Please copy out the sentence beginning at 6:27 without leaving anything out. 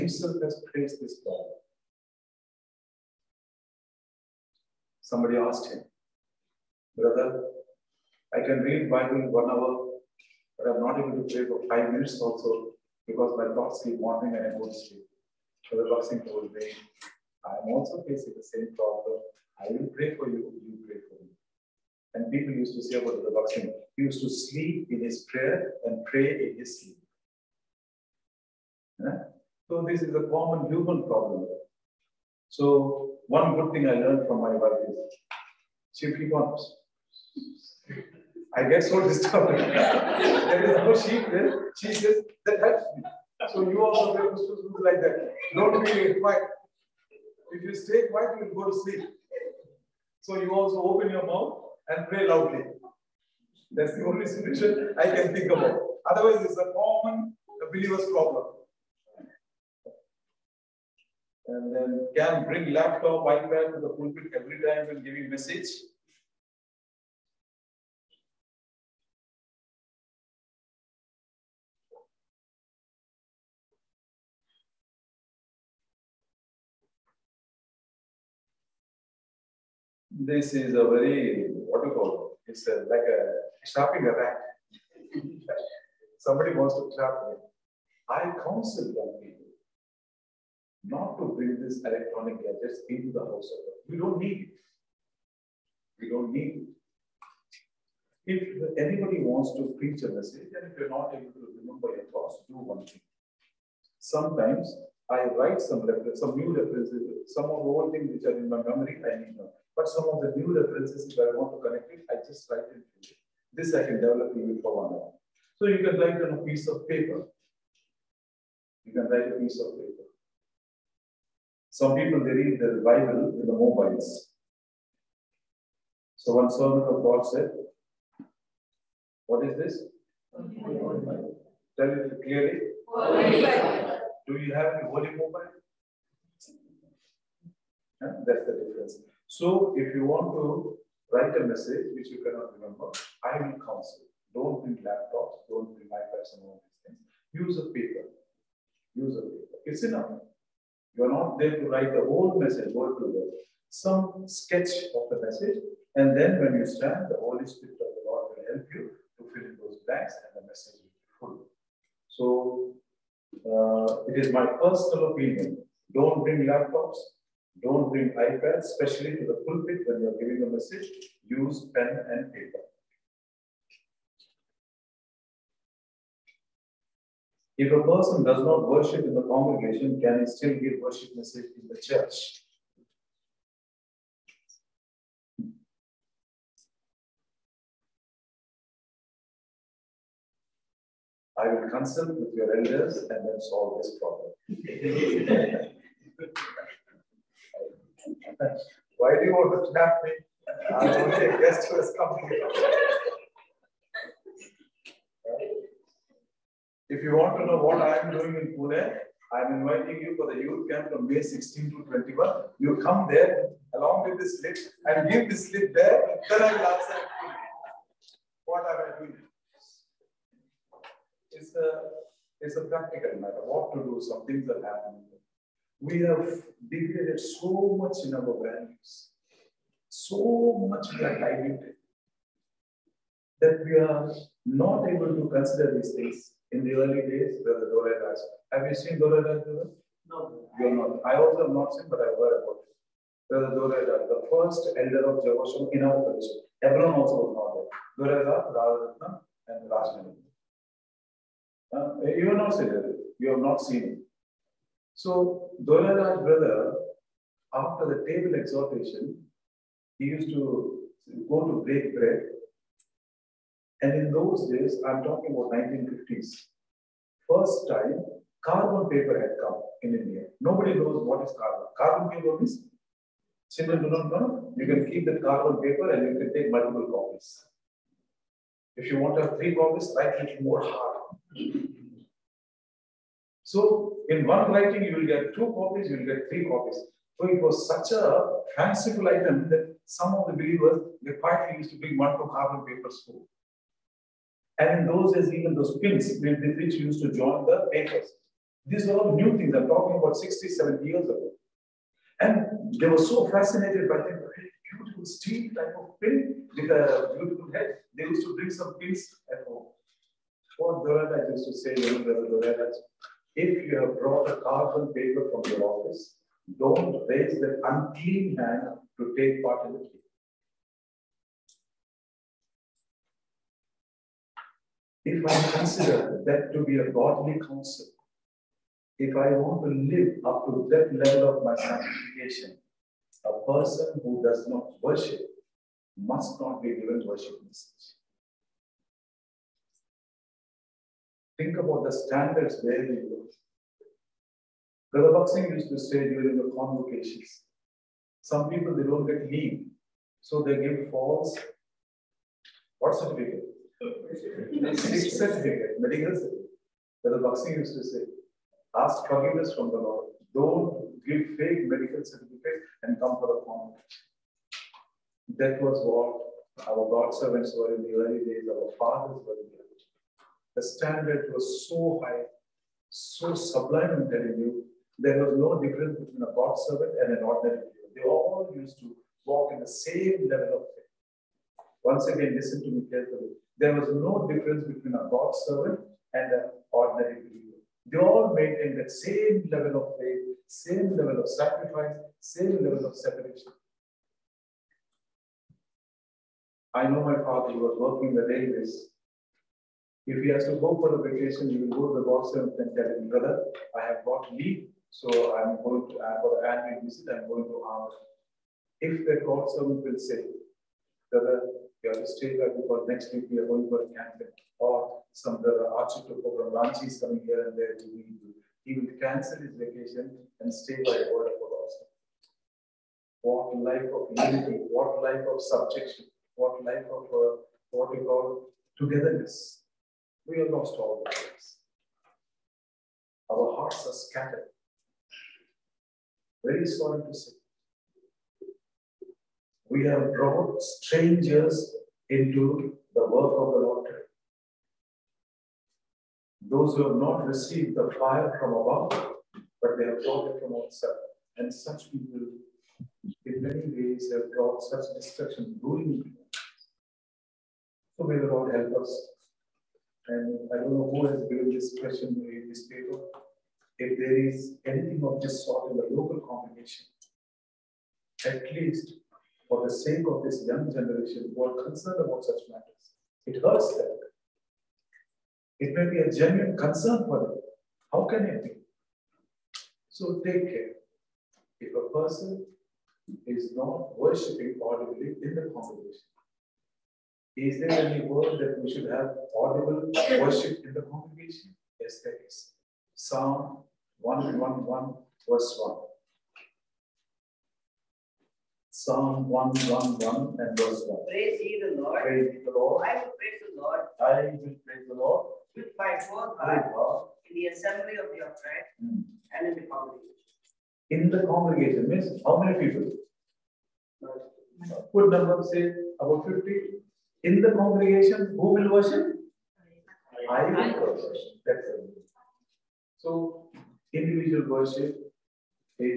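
They all maintained that same level of faith, same level of sacrifice, same level of separation.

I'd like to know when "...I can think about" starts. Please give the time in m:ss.
0:54.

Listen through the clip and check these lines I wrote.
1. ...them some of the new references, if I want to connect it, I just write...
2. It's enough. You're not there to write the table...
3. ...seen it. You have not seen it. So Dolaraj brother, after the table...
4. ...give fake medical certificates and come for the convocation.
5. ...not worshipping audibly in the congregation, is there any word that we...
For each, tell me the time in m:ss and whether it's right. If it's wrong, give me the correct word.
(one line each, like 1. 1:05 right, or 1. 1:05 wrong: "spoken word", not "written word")
1. 1:49 right
2. 2:29 wrong: "whole", not "table"
3. 4:12 right
4. 6:01 right
5. 8:03 right.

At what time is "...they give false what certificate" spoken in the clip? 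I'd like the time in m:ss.
5:50.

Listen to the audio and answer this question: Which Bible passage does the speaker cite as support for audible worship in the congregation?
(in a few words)
Psalm 111:1.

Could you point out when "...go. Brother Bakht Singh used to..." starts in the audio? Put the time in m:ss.
5:43.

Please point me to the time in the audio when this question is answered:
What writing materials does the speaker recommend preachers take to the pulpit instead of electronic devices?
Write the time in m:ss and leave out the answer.
2:51.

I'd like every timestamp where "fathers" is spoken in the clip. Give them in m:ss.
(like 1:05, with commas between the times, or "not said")
6:08, 6:37.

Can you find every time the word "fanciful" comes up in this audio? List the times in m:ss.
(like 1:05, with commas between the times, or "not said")
4:48.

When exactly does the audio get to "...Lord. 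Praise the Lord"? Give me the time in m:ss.
8:21.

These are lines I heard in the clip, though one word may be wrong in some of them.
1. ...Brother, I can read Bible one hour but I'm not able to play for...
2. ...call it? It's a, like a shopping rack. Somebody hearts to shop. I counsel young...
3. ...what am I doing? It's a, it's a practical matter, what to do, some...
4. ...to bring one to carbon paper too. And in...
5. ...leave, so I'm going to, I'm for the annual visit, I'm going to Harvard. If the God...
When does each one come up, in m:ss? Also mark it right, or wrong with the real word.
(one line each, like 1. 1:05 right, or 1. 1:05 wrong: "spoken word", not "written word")
1. 0:06 right
2. 1:21 wrong: "wants", not "hearts"
3. 3:38 right
4. 4:51 right
5. 6:44 right.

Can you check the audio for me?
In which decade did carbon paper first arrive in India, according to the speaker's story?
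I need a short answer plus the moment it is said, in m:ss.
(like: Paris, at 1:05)
1950s, at 4:25.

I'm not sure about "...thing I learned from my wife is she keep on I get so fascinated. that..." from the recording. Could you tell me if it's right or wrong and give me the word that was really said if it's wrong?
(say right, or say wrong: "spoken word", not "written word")
wrong: "disturbed", not "fascinated".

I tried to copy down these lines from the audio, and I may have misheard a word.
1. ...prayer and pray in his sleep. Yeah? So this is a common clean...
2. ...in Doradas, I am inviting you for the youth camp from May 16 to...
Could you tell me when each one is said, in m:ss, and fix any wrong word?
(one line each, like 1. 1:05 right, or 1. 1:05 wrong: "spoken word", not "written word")
1. 0:25 wrong: "human", not "clean"
2. 3:28 wrong: "Pune", not "Doradas".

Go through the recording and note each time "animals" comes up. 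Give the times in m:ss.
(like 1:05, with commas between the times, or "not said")
not said.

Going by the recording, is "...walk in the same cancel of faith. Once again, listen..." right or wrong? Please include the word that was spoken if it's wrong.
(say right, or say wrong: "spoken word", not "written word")
wrong: "level", not "cancel".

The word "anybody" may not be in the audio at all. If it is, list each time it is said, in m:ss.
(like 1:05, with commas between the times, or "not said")
1:38.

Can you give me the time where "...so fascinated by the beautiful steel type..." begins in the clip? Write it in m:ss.
5:03.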